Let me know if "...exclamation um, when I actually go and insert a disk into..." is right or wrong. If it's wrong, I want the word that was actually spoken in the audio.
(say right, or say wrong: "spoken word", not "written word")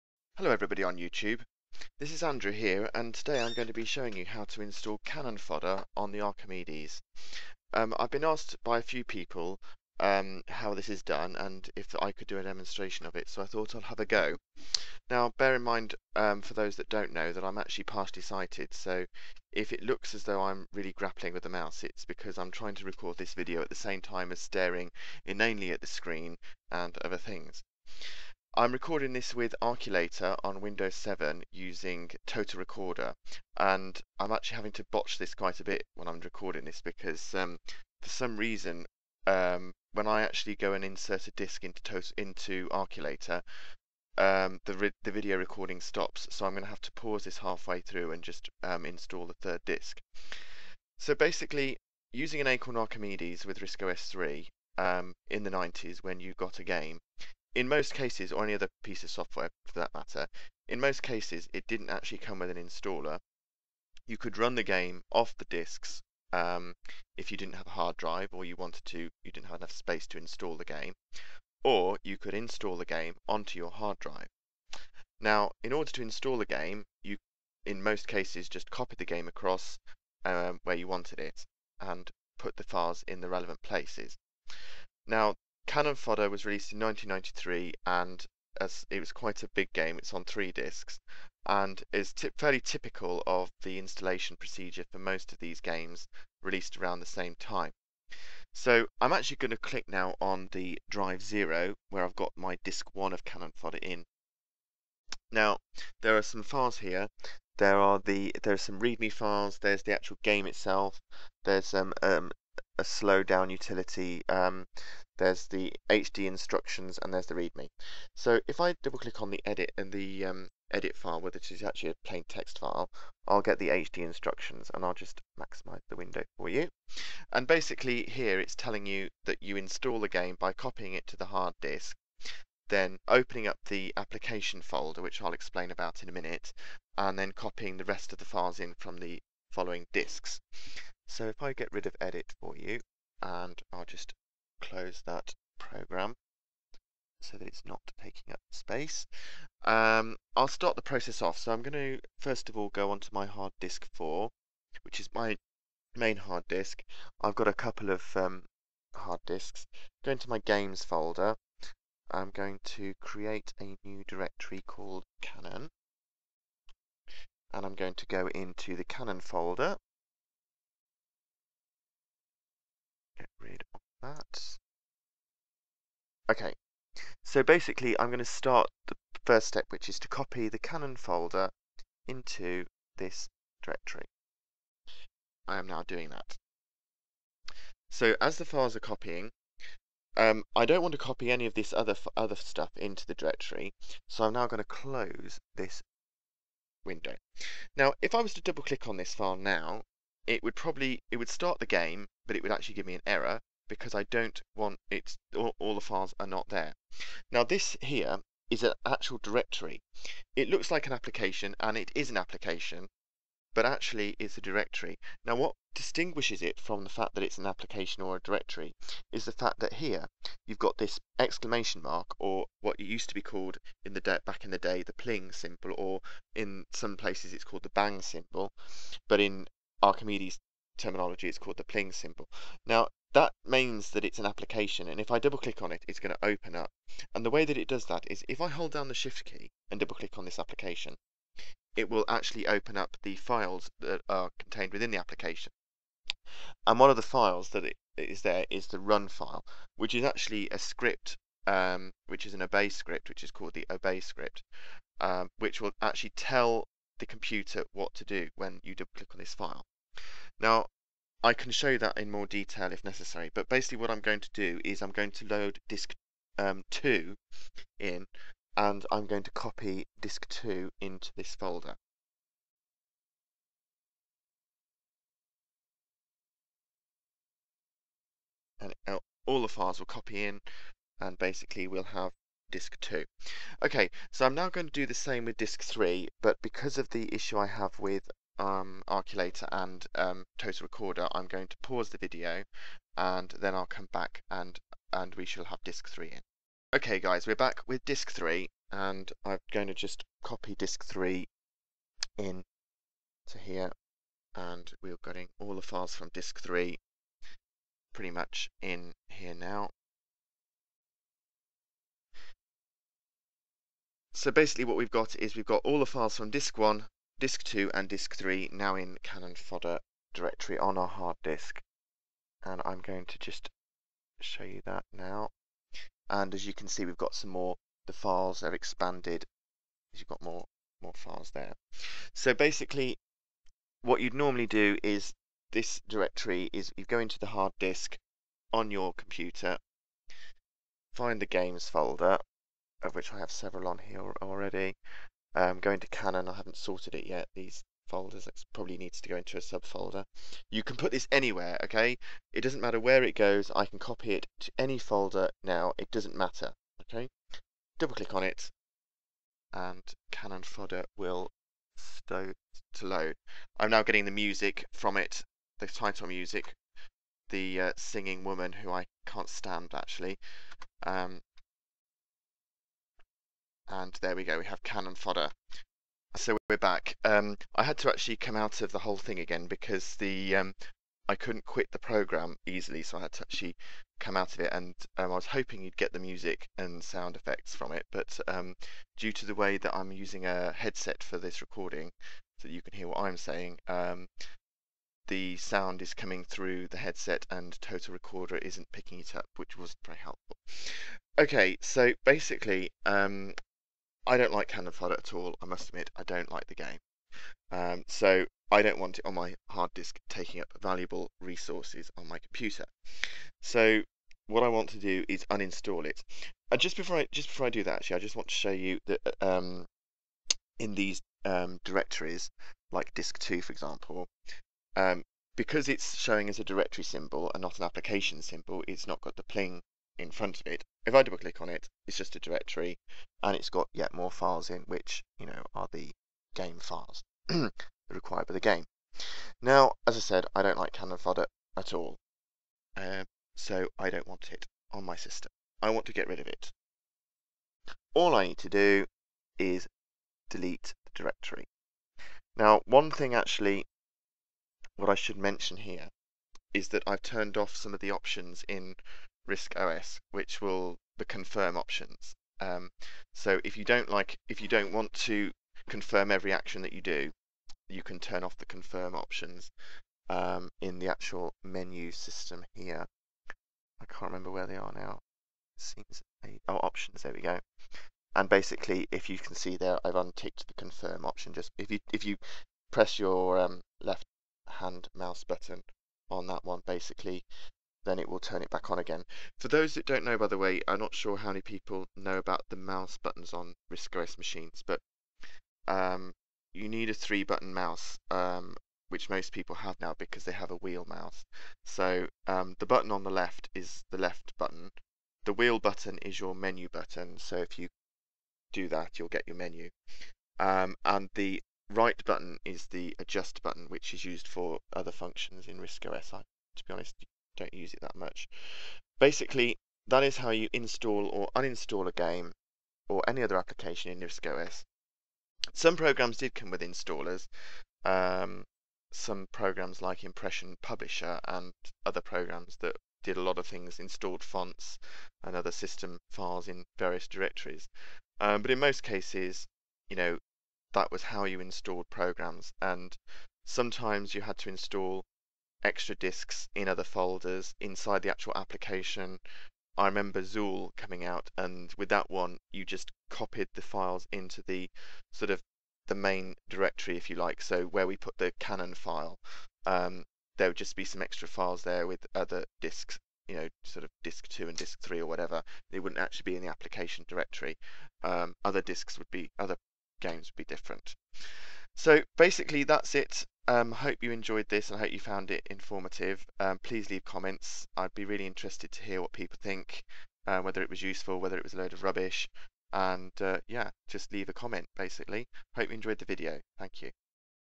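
wrong: "reason", not "exclamation".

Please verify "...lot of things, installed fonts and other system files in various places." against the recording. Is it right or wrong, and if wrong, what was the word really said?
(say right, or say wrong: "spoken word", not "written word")
wrong: "directories", not "places".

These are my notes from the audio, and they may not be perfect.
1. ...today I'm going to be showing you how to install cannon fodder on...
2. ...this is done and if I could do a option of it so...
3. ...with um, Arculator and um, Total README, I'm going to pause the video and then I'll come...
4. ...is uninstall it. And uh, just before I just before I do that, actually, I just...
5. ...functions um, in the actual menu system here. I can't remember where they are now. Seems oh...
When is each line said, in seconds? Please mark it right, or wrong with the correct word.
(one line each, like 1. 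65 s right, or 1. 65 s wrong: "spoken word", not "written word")
1. 3 s right
2. 10 s wrong: "demonstration", not "option"
3. 287 s wrong: "Recorder", not "README"
4. 415 s right
5. 468 s wrong: "options", not "functions".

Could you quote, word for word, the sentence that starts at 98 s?
So I'm actually going to click now on the drive zero where I've got my disk one of Cannon Fodder in.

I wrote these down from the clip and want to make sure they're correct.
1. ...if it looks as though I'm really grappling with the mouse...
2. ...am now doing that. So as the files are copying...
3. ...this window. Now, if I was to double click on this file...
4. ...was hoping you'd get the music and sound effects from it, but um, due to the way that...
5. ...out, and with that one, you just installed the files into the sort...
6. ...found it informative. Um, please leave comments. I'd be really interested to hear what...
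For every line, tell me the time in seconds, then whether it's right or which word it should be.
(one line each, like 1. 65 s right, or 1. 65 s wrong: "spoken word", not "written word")
1. 19 s right
2. 185 s right
3. 195 s right
4. 385 s right
5. 551 s wrong: "copied", not "installed"
6. 574 s right.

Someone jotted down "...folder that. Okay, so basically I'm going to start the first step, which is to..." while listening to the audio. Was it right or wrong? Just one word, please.
right.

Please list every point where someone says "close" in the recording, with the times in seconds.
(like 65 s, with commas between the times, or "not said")
144 s, 194 s.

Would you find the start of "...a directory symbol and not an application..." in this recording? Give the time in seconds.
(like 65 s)
426 s.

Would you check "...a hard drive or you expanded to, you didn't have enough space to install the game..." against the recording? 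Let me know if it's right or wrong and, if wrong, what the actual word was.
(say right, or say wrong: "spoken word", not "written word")
wrong: "wanted", not "expanded".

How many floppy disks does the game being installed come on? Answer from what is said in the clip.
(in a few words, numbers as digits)
3.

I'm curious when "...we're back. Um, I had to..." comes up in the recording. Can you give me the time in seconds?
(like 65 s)
376 s.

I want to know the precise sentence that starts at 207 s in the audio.
Now this here is an actual directory.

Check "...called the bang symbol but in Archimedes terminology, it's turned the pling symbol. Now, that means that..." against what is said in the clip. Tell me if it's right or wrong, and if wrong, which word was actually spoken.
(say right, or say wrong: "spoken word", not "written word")
wrong: "called", not "turned".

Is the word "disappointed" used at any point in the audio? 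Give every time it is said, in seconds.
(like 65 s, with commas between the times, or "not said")
not said.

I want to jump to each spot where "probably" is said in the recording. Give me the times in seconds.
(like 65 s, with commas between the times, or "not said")
200 s, 348 s.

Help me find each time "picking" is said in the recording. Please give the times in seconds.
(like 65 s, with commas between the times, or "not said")
398 s.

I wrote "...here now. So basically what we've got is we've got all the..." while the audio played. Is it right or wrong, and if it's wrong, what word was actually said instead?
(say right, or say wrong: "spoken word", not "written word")
right.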